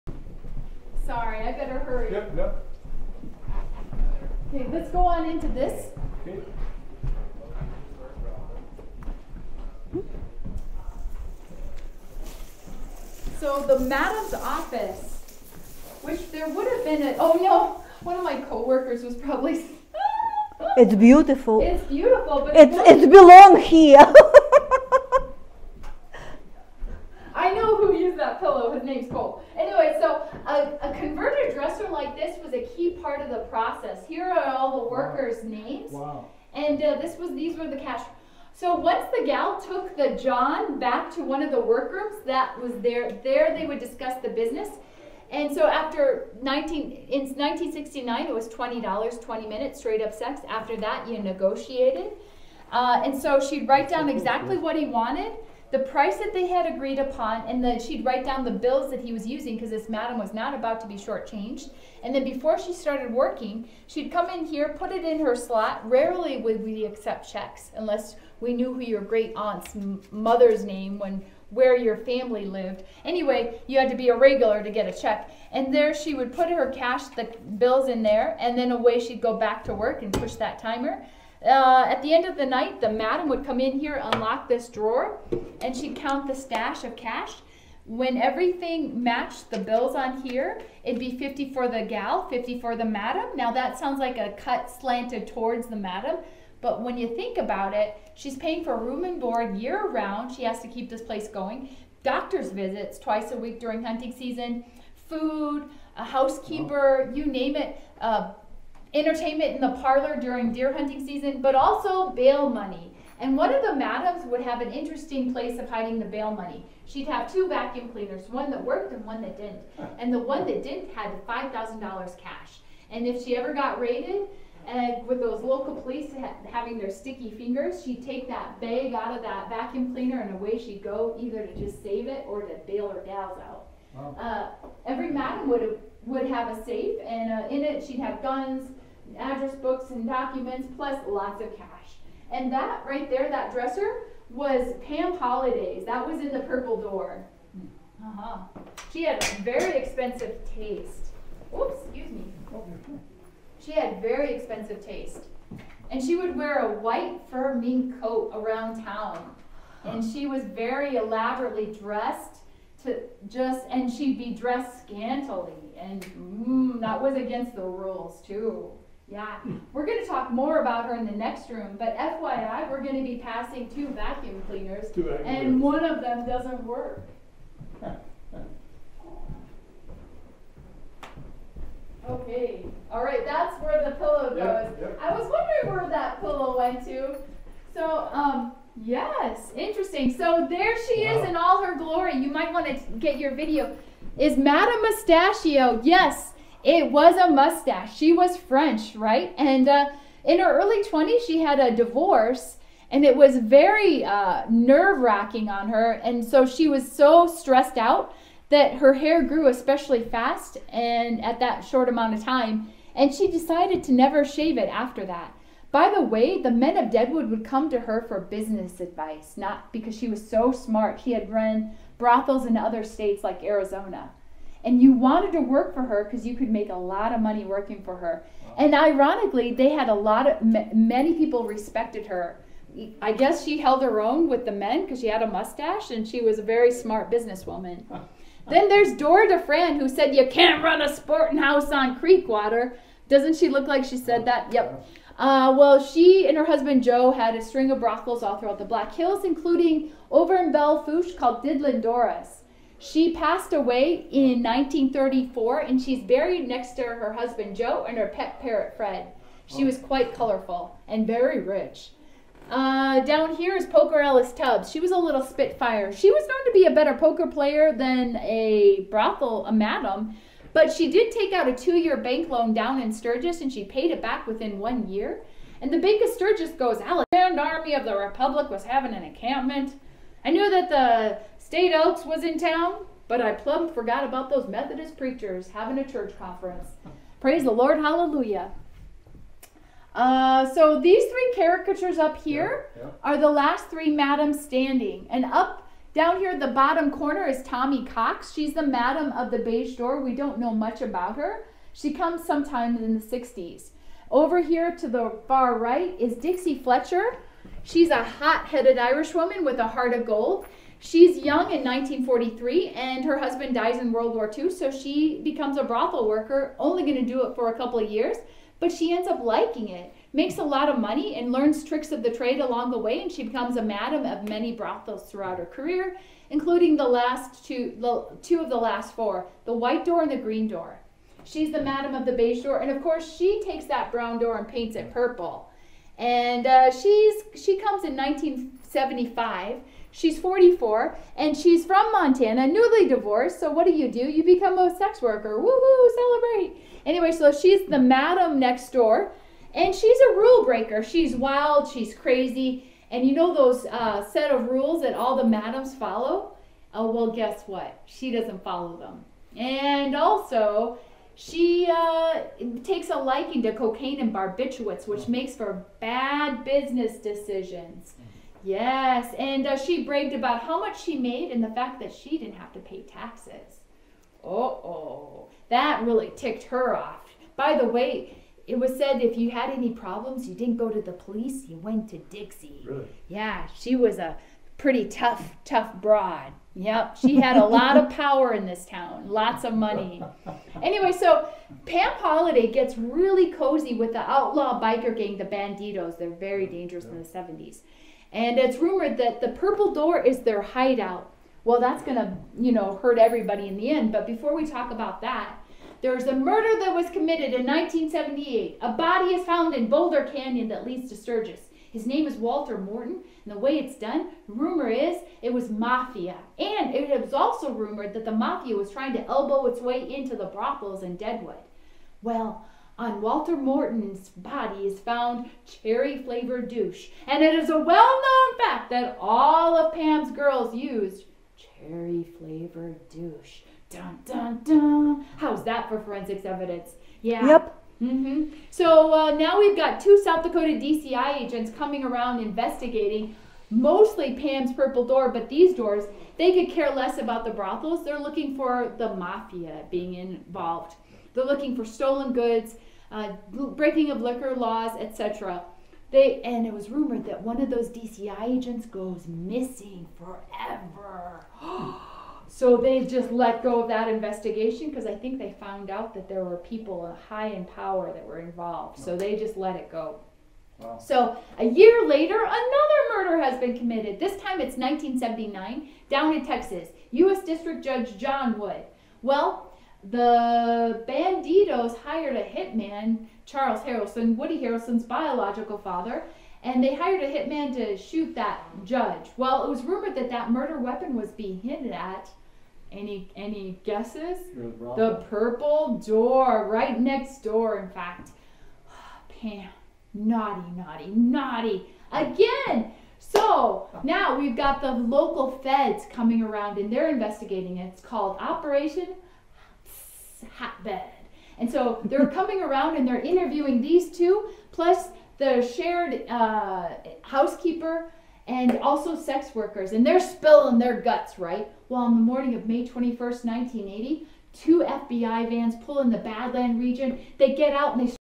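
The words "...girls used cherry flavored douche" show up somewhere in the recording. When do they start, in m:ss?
7:10.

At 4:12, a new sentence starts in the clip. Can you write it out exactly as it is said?
She passed away in 1934, and she's buried next to her husband Joe and her pet parrot Fred.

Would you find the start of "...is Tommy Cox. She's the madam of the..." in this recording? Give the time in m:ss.
4:57.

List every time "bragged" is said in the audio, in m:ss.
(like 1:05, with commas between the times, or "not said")
6:09.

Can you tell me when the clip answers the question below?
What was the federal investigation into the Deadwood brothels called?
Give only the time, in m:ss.
8:28.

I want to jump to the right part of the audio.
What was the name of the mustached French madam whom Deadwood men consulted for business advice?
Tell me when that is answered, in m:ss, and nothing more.
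3:14.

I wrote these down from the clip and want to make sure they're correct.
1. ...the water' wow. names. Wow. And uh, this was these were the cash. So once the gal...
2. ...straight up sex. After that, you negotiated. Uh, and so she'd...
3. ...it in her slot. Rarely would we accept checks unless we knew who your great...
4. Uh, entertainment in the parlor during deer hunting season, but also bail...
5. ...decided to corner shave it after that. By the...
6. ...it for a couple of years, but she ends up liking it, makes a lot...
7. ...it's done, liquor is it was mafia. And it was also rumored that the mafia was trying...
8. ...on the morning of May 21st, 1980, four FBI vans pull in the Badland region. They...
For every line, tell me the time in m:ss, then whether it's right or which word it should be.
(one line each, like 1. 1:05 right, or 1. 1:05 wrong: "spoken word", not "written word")
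1. 0:34 wrong: "workers", not "water"
2. 0:49 right
3. 1:04 right
4. 1:47 right
5. 3:33 wrong: "never", not "corner"
6. 5:17 right
7. 6:53 wrong: "rumor", not "liquor"
8. 8:41 wrong: "two", not "four".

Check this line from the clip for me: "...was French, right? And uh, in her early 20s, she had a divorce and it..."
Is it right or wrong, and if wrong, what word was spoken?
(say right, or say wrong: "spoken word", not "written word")
right.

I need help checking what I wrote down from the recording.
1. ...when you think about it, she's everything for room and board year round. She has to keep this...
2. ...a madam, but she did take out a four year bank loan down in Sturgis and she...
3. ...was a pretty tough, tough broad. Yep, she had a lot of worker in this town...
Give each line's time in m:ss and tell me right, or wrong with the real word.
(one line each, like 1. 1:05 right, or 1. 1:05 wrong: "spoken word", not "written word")
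1. 1:36 wrong: "paying", not "everything"
2. 4:29 wrong: "two", not "four"
3. 6:23 wrong: "power", not "worker".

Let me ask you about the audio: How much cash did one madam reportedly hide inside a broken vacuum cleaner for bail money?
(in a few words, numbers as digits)
$5,000.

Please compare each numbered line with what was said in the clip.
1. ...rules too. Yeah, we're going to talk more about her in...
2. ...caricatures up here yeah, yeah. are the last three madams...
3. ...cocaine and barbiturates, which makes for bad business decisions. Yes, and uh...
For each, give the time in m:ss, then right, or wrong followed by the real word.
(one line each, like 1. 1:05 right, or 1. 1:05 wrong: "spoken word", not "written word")
1. 2:47 right
2. 4:51 right
3. 6:03 right.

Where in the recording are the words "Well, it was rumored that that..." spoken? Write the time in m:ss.
8:09.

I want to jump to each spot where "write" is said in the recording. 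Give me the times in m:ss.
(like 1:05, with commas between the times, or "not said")
0:53, 0:58.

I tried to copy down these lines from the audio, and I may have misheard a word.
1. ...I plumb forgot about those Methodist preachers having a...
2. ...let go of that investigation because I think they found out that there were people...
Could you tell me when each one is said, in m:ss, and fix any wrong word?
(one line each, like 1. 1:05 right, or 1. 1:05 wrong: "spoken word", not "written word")
1. 4:43 right
2. 7:43 right.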